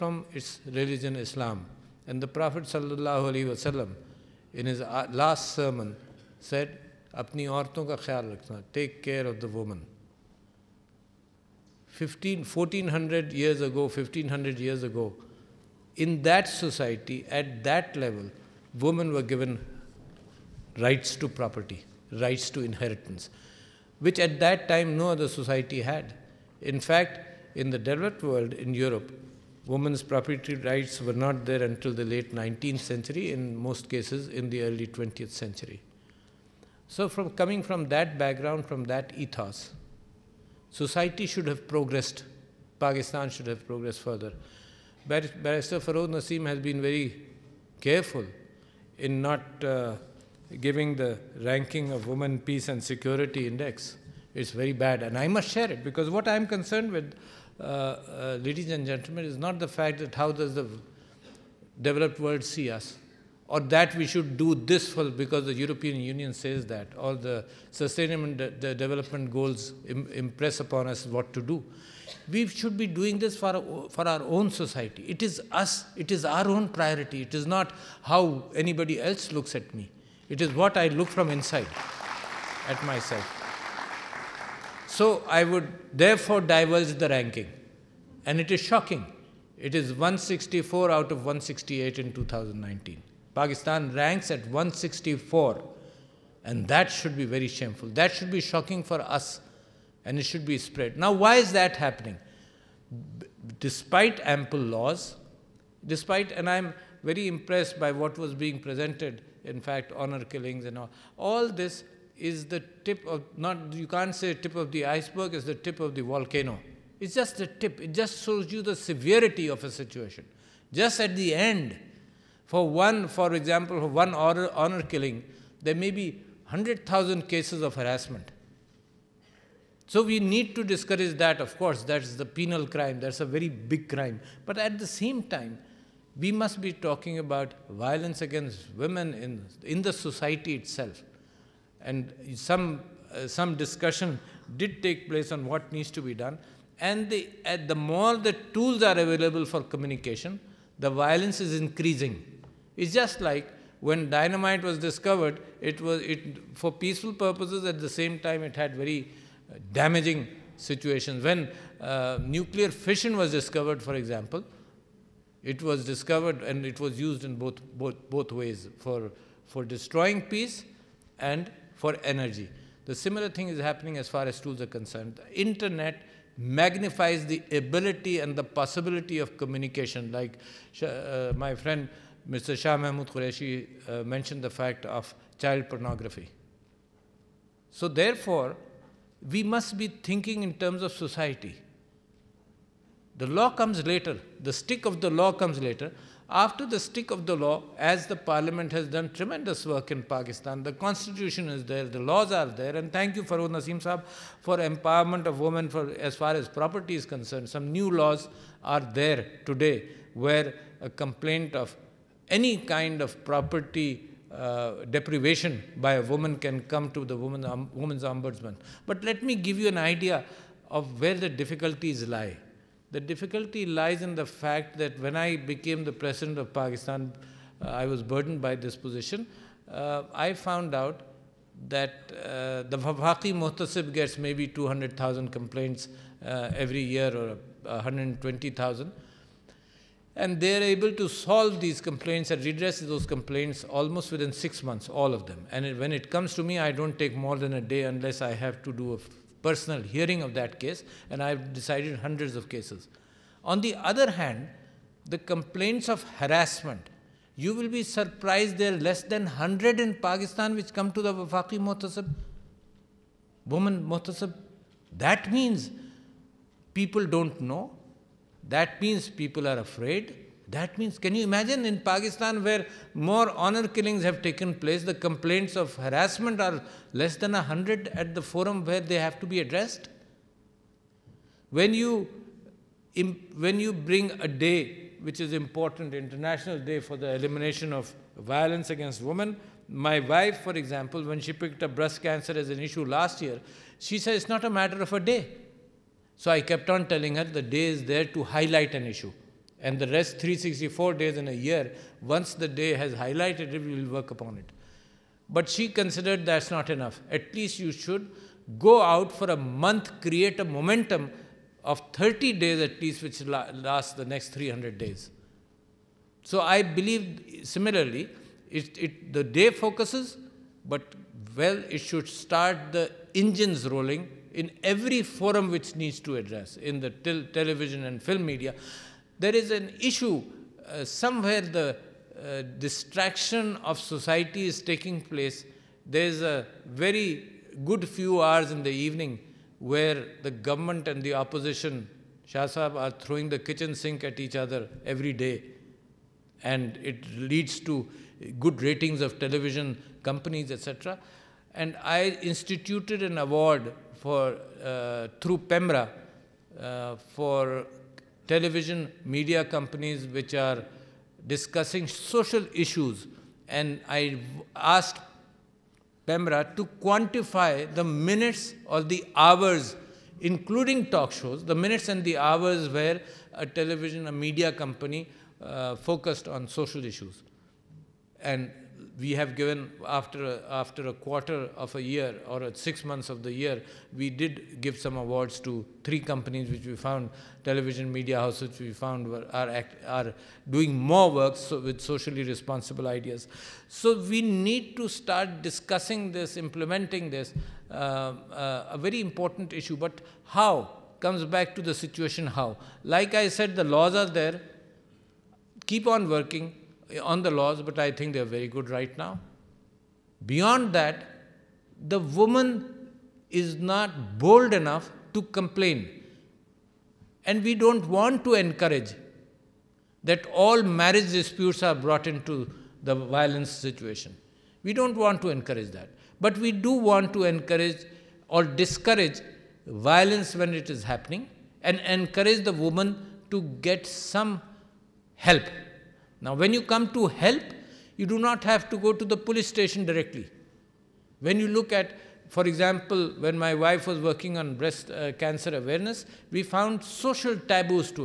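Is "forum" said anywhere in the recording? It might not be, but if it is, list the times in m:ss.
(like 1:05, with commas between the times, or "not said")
4:38, 5:25.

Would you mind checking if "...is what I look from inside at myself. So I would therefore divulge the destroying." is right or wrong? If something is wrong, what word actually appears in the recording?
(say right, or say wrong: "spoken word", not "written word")
wrong: "ranking", not "destroying".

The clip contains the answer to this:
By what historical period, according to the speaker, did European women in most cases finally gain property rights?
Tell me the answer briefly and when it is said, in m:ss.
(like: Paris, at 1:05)
early 20th century, at 0:34.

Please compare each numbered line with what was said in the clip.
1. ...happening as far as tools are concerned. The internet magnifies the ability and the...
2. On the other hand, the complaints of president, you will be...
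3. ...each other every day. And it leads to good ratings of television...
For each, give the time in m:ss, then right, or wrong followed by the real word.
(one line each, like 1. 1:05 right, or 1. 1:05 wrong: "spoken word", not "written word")
1. 2:53 right
2. 4:13 wrong: "harassment", not "president"
3. 5:44 right.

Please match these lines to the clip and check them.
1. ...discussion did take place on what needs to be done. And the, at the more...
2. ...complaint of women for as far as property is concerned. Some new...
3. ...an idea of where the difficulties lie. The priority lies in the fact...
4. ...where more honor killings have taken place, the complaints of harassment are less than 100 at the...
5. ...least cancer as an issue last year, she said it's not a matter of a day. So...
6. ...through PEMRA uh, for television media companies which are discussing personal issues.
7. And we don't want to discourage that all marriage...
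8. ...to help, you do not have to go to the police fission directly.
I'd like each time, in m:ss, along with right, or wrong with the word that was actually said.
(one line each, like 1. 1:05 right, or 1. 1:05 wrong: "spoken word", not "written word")
1. 2:23 right
2. 3:24 wrong: "empowerment", not "complaint"
3. 3:39 wrong: "difficulty", not "priority"
4. 4:32 right
5. 4:51 wrong: "breast", not "least"
6. 5:55 wrong: "social", not "personal"
7. 6:57 wrong: "encourage", not "discourage"
8. 7:16 wrong: "station", not "fission".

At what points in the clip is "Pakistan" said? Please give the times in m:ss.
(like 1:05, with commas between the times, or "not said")
0:42, 1:33, 3:20, 3:46, 4:19, 4:31.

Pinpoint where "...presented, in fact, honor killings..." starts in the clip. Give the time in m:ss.
1:48.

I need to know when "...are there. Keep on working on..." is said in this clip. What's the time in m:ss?
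6:43.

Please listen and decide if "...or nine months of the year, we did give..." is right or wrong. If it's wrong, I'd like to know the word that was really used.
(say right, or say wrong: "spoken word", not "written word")
wrong: "six", not "nine".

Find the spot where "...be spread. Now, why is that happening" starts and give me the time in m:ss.
1:40.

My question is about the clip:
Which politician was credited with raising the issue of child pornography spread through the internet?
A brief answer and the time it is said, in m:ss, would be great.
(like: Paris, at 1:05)
Shah Mahmood Qureshi, at 3:02.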